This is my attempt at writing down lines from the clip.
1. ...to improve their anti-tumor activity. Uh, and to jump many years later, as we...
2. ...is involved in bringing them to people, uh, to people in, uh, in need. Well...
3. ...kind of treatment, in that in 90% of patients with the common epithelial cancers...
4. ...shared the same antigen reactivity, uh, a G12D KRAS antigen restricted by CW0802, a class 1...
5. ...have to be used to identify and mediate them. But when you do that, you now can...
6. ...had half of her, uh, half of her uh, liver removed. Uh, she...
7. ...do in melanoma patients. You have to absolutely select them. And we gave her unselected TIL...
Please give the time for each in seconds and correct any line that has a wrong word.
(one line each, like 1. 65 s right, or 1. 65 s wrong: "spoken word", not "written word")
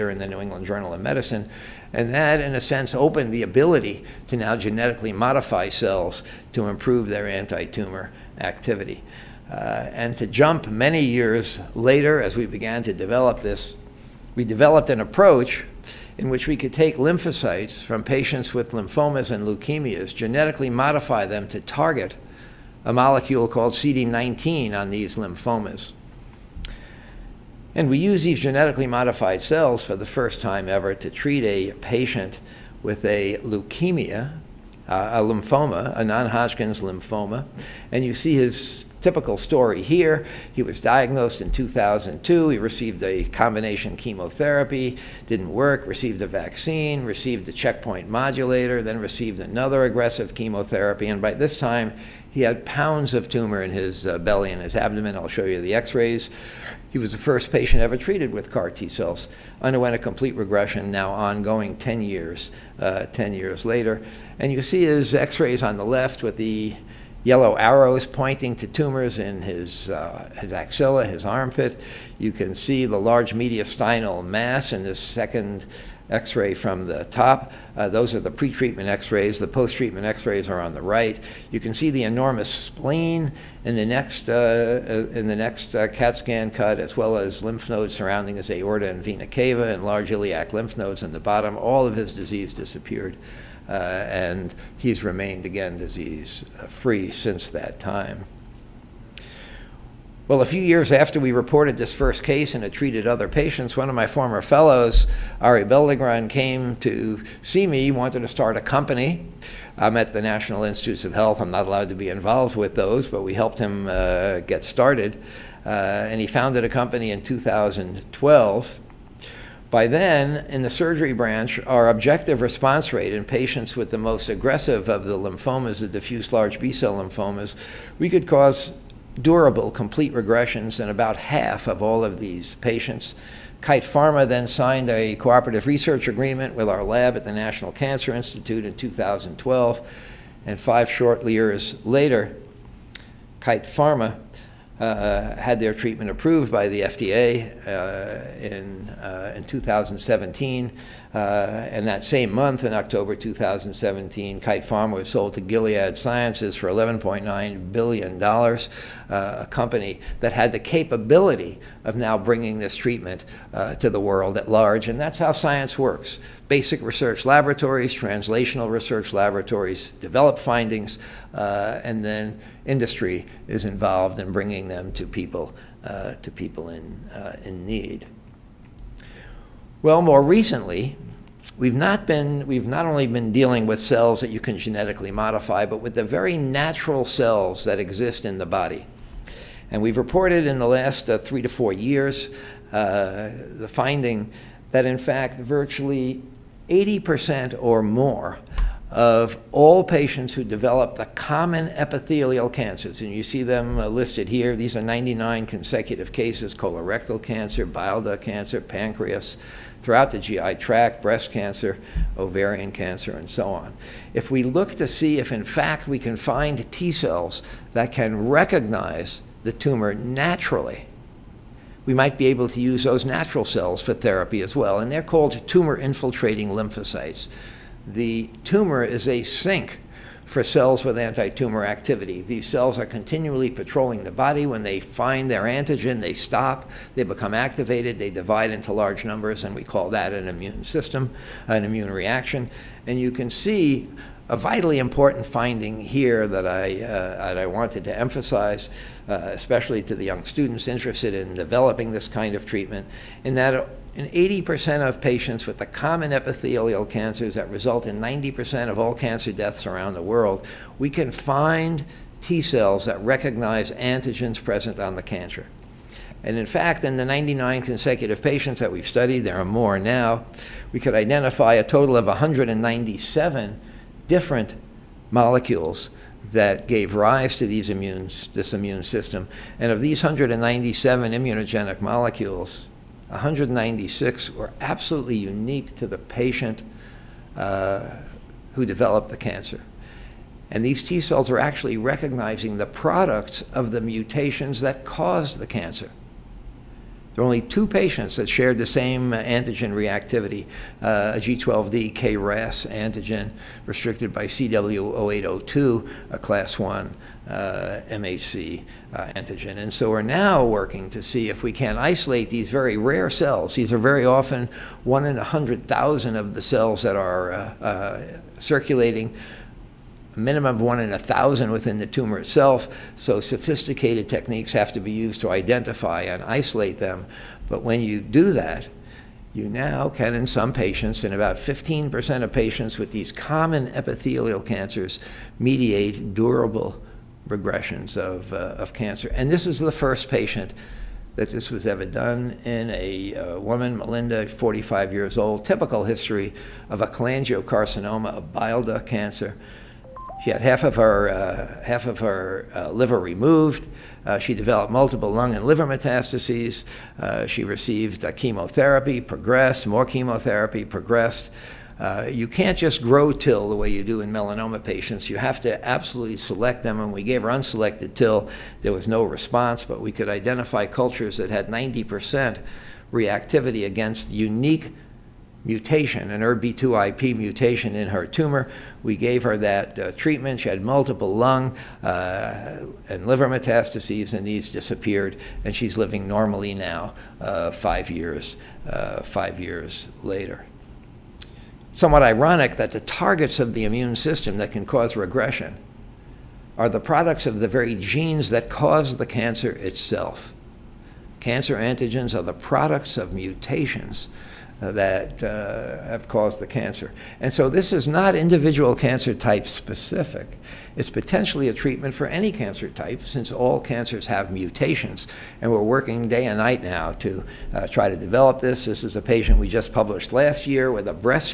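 1. 6 s right
2. 173 s right
3. 252 s wrong: "80", not "90"
4. 298 s right
5. 324 s wrong: "isolate", not "mediate"
6. 350 s right
7. 363 s right.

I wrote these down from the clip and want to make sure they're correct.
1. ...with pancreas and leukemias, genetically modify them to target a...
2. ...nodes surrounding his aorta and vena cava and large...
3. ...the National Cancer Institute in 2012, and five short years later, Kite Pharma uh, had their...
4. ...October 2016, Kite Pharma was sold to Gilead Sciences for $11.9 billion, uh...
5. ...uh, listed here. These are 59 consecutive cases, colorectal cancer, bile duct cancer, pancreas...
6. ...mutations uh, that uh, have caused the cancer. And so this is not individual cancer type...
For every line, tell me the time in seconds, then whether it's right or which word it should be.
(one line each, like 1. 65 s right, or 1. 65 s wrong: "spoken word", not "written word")
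1. 18 s wrong: "lymphomas", not "pancreas"
2. 87 s right
3. 137 s right
4. 152 s wrong: "2017", not "2016"
5. 203 s wrong: "99", not "59"
6. 403 s right.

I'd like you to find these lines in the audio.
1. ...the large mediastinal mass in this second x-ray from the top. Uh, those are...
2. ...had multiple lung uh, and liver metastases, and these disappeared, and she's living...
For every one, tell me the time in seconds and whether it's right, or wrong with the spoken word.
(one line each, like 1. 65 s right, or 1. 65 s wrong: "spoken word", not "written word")
1. 72 s right
2. 380 s right.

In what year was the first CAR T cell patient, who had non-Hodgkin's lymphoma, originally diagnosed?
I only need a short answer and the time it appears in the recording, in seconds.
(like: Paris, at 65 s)
2002, at 41 s.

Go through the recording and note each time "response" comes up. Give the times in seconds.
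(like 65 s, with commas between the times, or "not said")
122 s, 369 s.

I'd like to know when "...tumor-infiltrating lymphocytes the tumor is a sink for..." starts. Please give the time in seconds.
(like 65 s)
225 s.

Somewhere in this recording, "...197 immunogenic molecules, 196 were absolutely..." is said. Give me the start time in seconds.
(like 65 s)
280 s.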